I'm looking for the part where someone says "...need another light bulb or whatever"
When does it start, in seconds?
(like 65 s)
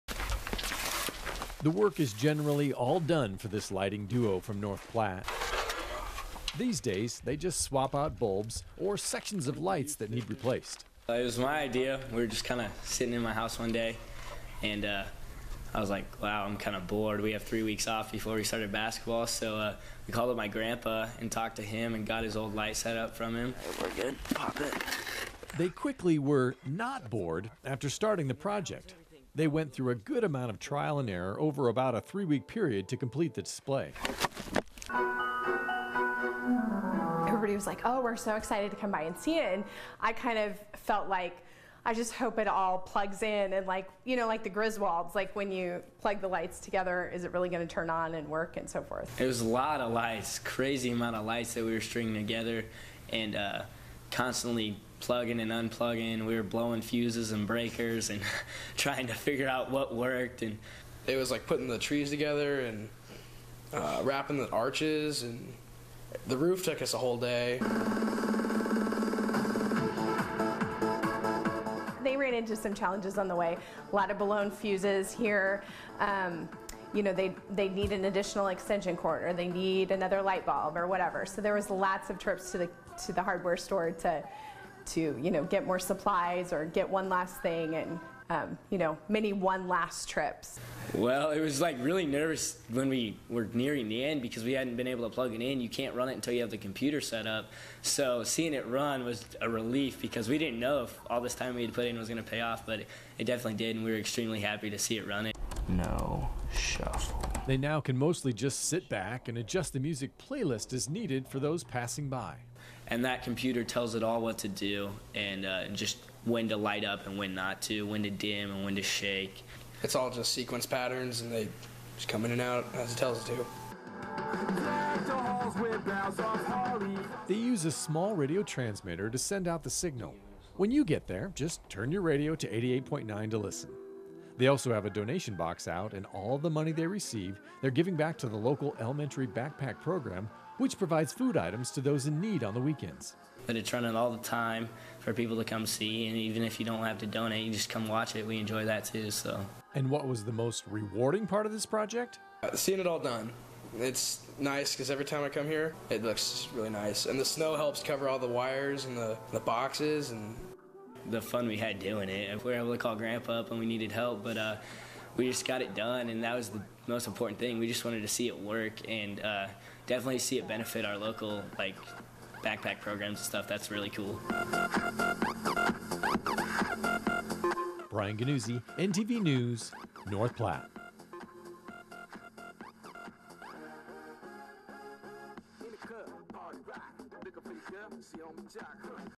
79 s.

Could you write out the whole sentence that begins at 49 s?
It was a lot of lights, crazy amount of lights that we were stringing together, and uh, constantly plugging and unplugging.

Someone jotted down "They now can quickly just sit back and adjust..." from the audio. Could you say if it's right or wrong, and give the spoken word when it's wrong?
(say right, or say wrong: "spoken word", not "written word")
wrong: "mostly", not "quickly".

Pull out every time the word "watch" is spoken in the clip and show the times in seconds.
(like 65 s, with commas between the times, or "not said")
147 s.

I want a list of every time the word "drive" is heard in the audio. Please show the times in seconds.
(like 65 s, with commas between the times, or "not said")
not said.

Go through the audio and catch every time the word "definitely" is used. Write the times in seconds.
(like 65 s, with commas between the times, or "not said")
103 s, 169 s.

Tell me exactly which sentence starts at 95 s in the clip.
You can't run it until you have the computer set up.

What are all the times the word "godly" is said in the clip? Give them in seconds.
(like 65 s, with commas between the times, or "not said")
not said.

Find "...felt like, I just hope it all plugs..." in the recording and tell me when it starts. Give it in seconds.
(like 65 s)
40 s.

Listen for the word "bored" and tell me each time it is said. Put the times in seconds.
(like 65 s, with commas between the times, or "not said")
16 s, 27 s.